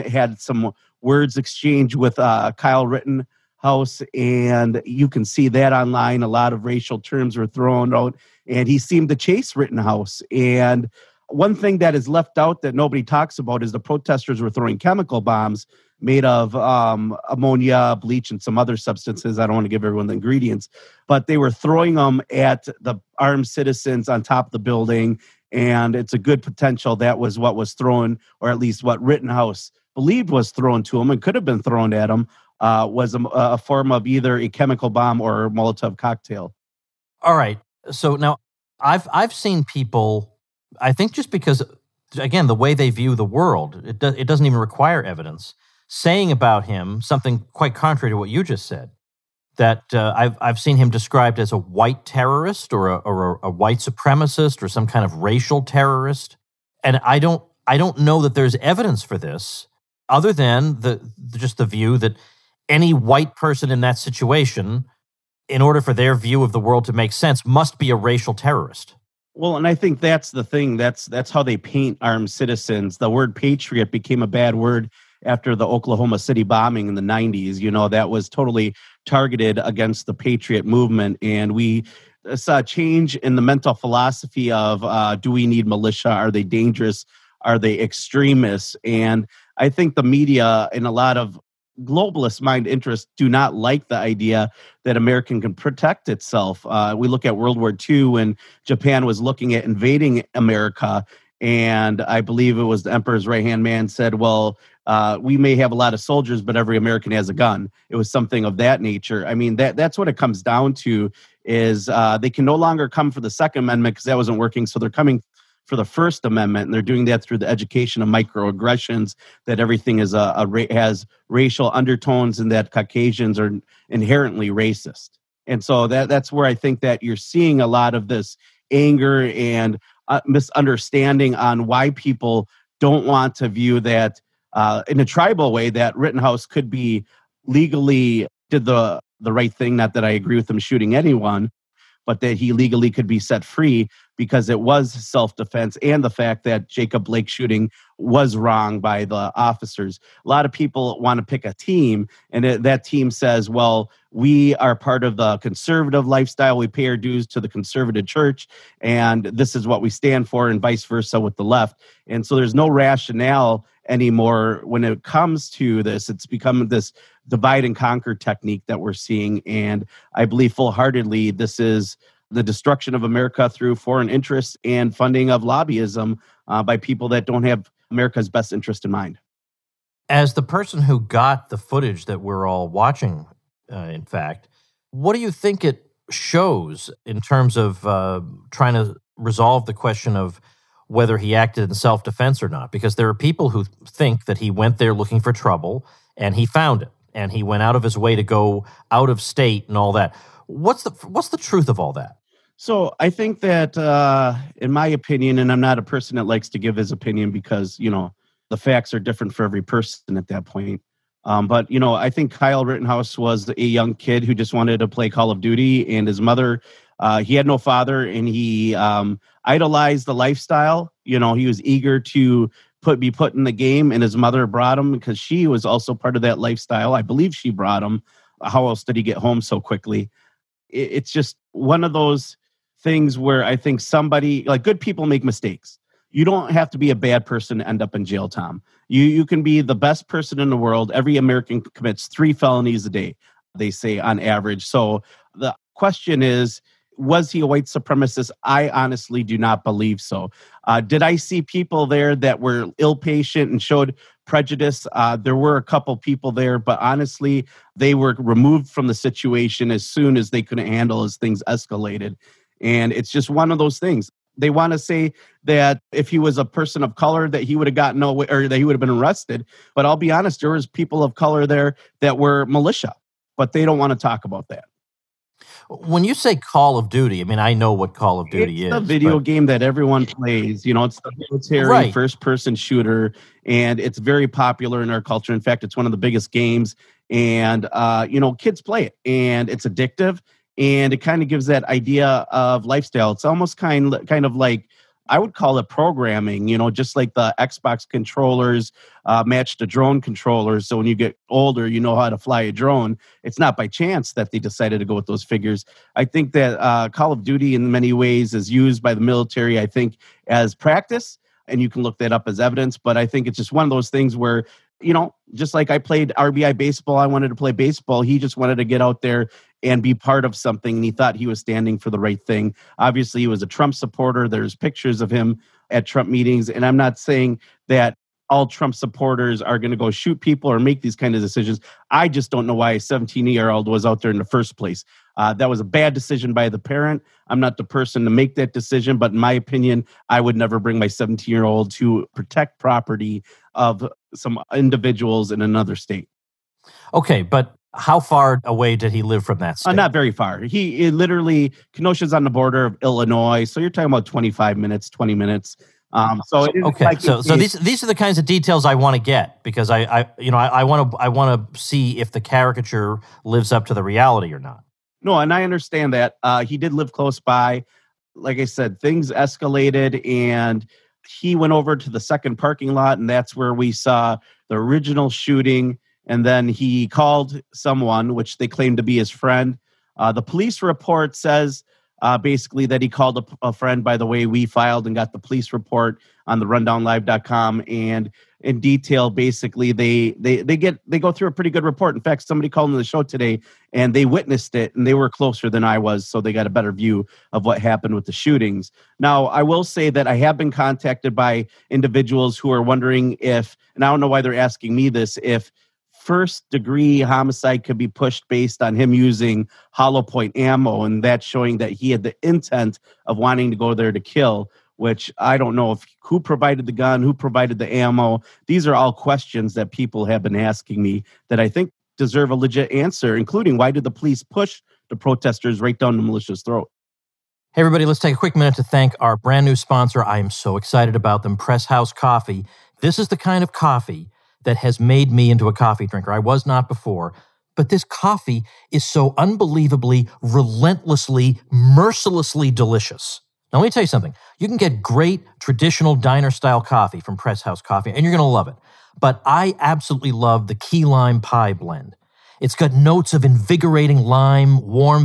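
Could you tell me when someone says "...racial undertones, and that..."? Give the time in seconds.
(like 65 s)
121 s.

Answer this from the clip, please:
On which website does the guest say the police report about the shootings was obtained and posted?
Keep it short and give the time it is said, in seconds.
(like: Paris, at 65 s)
rundownlive.com, at 386 s.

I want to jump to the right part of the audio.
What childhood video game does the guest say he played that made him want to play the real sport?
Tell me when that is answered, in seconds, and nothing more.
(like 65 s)
316 s.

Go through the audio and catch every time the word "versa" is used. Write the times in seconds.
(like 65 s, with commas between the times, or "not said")
160 s.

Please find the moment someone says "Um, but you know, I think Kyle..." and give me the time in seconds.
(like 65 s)
211 s.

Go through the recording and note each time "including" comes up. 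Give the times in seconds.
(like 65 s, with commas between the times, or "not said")
423 s.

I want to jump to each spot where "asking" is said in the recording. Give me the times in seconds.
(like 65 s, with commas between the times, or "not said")
404 s, 420 s.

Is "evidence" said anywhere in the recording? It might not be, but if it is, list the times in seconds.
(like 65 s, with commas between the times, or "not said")
45 s, 58 s, 312 s.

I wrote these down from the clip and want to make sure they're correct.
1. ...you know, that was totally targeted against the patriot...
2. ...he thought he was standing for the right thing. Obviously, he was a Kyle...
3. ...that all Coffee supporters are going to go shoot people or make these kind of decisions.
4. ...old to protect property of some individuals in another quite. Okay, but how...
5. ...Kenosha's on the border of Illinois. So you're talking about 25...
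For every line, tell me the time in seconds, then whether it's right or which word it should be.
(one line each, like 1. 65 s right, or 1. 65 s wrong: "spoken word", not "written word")
1. 77 s right
2. 320 s wrong: "Trump", not "Kyle"
3. 327 s wrong: "Trump", not "Coffee"
4. 341 s wrong: "state", not "quite"
5. 351 s right.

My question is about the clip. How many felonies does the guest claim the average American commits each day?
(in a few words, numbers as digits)
3.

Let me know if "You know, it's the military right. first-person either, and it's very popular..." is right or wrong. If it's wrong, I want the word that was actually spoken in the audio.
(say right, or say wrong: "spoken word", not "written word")
wrong: "shooter", not "either".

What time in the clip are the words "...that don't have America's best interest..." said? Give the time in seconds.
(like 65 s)
177 s.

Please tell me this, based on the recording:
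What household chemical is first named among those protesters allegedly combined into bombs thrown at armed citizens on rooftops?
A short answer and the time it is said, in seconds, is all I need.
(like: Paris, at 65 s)
ammonia, at 17 s.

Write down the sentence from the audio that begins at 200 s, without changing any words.
What's the what's the truth of all that?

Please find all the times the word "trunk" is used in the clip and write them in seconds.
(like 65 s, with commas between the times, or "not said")
not said.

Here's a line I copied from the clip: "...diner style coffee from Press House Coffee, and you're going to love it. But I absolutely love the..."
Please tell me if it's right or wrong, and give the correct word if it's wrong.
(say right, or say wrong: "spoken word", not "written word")
right.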